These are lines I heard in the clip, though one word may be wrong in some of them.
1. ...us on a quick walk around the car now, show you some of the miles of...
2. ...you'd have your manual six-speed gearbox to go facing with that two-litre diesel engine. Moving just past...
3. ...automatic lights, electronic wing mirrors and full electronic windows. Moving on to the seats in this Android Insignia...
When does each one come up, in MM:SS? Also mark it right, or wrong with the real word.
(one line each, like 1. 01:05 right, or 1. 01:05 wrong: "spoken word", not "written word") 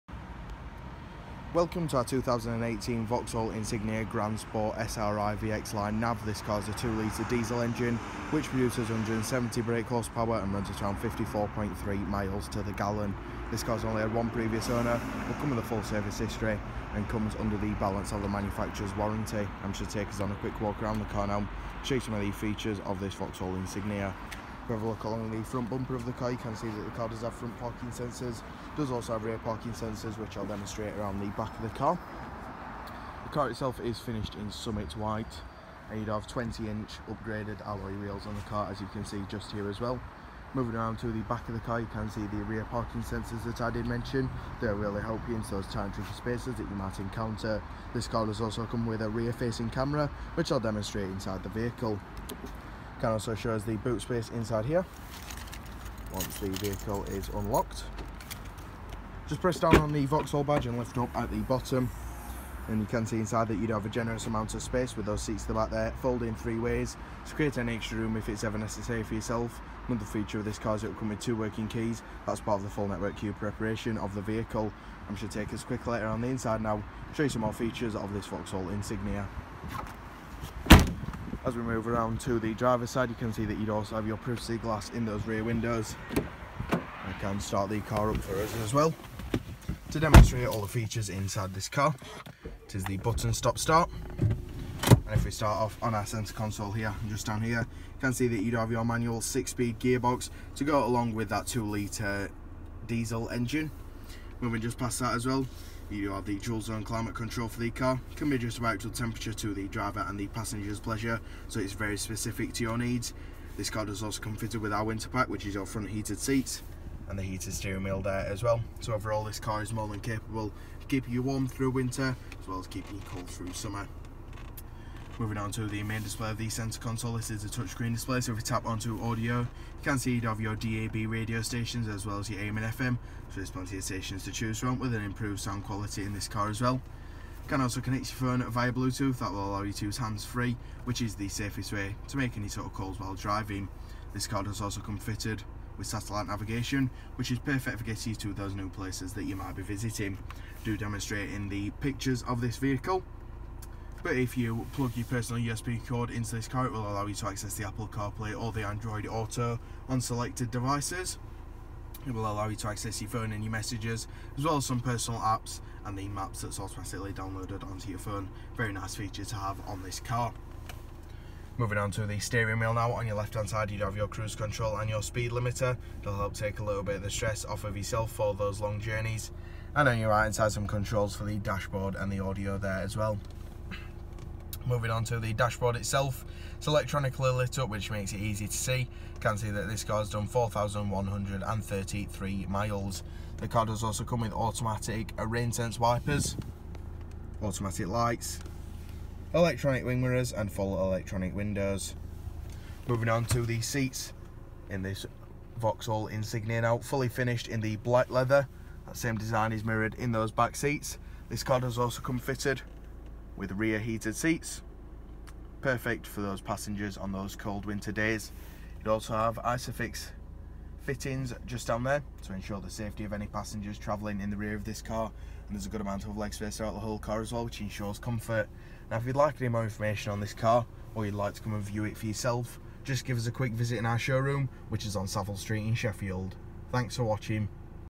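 1. 00:20 wrong: "features", not "miles"
2. 01:38 wrong: "along", not "facing"
3. 03:17 wrong: "Vauxhall", not "Android".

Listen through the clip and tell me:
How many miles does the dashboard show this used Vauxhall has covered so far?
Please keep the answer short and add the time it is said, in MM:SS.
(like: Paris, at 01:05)
4,133, at 03:10.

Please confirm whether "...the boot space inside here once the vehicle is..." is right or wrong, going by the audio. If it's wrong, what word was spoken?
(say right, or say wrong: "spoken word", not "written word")
right.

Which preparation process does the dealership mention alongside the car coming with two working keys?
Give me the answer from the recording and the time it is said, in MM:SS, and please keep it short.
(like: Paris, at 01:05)
Network Q, at 01:12.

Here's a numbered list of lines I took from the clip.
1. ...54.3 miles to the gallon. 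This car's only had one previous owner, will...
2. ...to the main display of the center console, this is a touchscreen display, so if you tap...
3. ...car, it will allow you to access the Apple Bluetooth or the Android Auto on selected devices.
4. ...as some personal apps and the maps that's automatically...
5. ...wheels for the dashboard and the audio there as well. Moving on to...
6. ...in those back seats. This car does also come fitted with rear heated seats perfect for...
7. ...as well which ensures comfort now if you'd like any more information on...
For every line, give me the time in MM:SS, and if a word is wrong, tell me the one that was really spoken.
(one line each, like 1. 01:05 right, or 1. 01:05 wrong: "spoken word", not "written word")
1. 00:11 right
2. 02:05 right
3. 02:36 wrong: "CarPlay", not "Bluetooth"
4. 02:44 right
5. 03:00 wrong: "controls", not "wheels"
6. 03:29 right
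7. 03:47 right.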